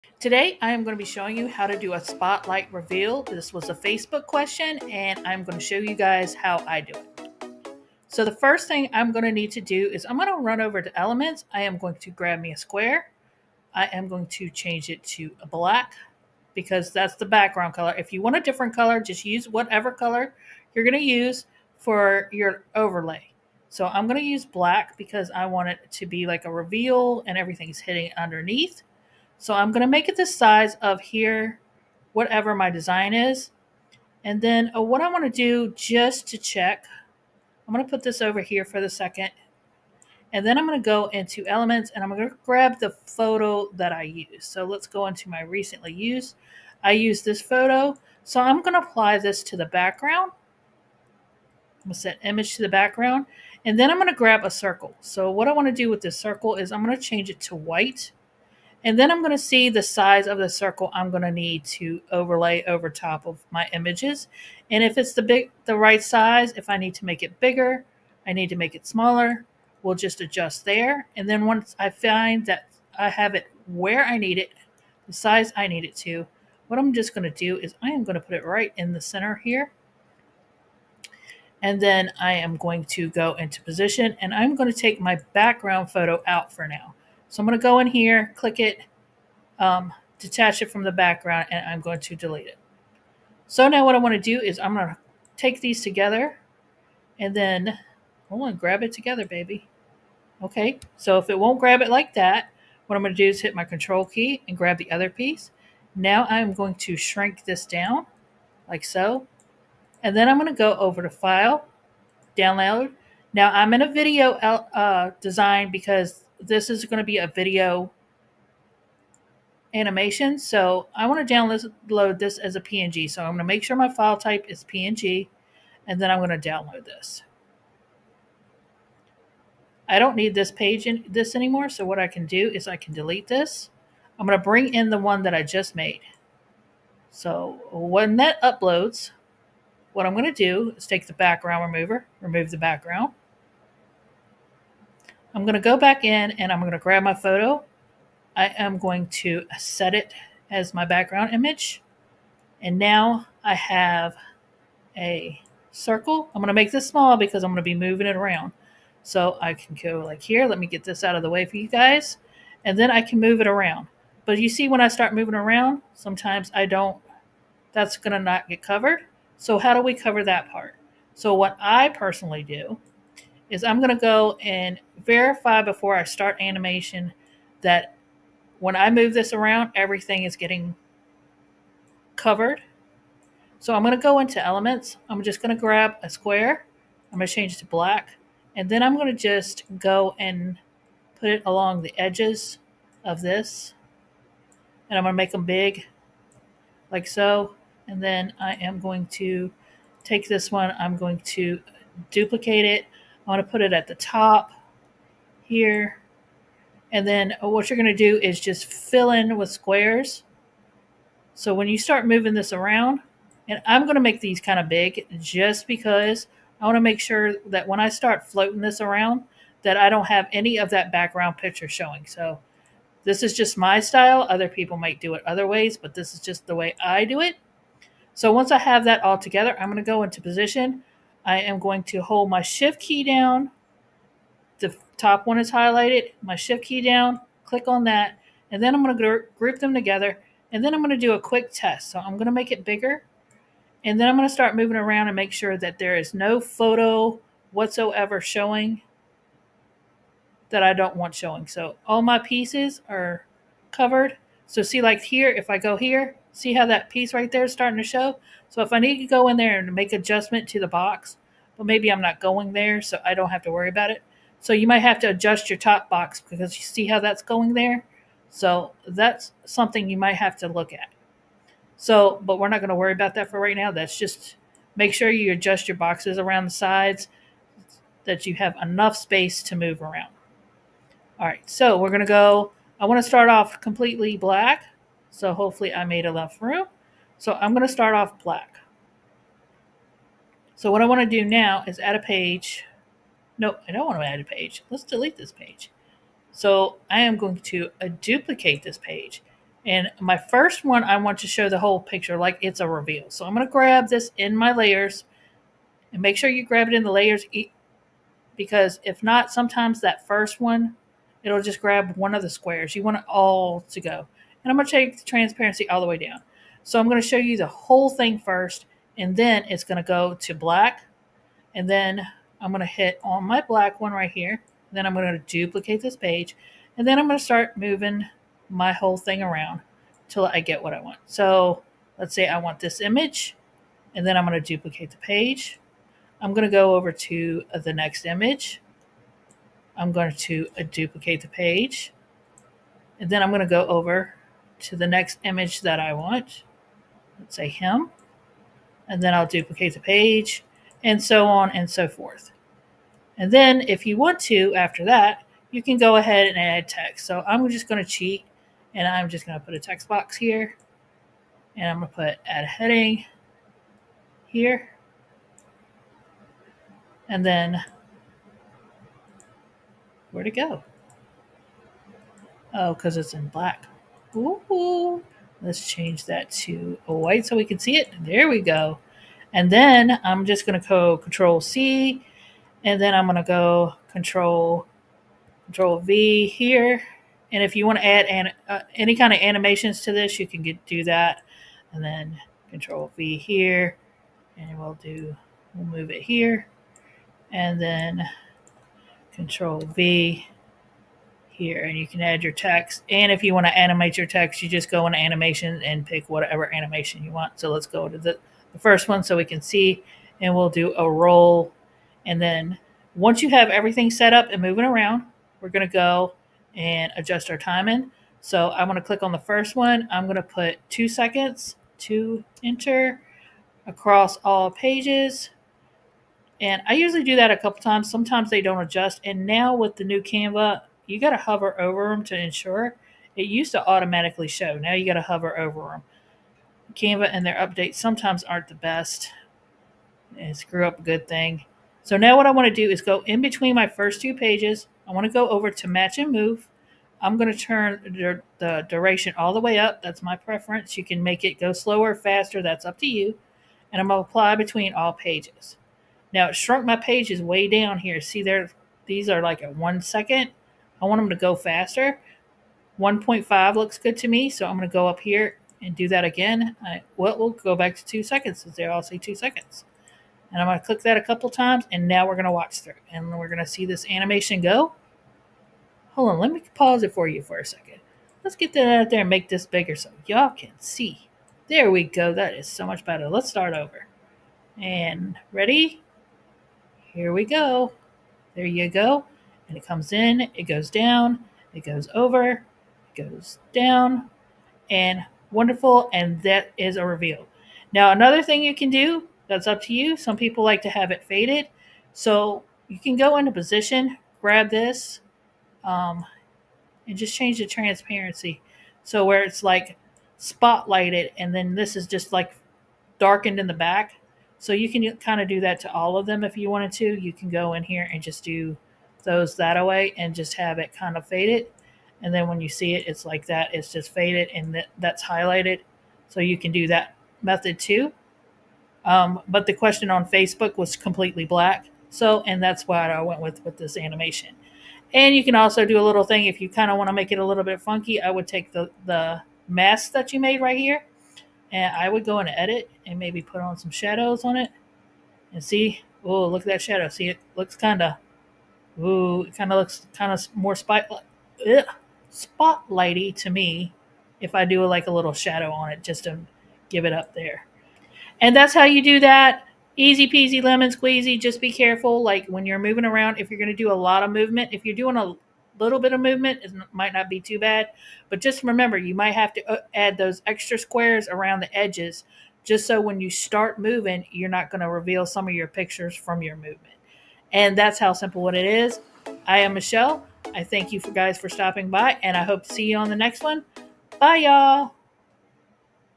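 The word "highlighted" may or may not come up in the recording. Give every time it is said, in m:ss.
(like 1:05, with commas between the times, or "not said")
3:55, 8:45.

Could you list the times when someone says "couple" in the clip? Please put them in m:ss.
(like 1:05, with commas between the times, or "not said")
7:07, 7:51.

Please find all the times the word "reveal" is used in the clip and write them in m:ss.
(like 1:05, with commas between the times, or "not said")
0:02, 0:26, 5:02, 8:16, 9:34.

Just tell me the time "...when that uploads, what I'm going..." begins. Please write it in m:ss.
2:17.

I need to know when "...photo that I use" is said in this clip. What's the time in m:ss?
0:43.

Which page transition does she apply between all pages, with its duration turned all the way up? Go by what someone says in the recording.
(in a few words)
Match and move.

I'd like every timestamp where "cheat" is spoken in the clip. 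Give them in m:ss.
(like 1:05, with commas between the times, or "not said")
5:57.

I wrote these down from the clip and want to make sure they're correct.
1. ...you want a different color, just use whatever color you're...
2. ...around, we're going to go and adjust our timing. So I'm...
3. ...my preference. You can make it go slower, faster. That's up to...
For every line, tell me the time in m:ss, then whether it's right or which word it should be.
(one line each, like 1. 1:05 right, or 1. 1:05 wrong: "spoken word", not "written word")
1. 0:18 right
2. 6:54 right
3. 7:30 right.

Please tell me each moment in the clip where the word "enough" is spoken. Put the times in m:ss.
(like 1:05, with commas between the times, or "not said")
4:38, 4:46.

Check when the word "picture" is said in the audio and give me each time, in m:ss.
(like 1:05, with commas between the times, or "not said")
3:41, 5:01, 9:35.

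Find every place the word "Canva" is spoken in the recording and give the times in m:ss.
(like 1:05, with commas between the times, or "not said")
7:10, 7:16.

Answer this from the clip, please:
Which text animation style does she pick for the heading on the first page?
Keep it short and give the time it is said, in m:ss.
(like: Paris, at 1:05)
Roll, at 6:50.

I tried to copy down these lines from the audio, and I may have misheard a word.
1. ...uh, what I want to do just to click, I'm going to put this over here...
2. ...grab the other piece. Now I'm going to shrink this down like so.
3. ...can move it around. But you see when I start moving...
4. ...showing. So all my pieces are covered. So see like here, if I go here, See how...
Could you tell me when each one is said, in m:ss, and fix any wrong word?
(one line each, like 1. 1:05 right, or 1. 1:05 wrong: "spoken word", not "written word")
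1. 0:34 wrong: "check", not "click"
2. 1:44 right
3. 2:43 right
4. 4:11 right.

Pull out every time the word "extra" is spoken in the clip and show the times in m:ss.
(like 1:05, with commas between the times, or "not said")
9:30.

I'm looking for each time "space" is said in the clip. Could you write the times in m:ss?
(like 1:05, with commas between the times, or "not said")
4:38.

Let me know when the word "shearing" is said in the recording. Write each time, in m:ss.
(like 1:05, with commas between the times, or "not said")
not said.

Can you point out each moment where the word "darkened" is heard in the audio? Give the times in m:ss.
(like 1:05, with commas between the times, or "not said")
8:32.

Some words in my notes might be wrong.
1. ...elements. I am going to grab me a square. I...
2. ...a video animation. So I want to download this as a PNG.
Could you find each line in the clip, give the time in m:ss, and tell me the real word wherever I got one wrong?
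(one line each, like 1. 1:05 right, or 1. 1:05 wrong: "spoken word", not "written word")
1. 0:10 right
2. 1:57 right.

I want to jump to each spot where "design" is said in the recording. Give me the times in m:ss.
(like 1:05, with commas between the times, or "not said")
0:32, 1:55.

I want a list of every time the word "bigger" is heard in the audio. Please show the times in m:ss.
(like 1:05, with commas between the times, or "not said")
1:07, 4:02, 7:59.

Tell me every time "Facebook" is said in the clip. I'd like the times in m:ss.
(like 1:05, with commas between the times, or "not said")
0:03, 8:50.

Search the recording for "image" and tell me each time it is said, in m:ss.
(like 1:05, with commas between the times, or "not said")
0:52, 1:03, 2:31, 5:32, 5:38, 5:45.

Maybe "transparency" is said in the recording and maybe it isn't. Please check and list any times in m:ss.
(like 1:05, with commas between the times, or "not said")
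5:15, 8:27.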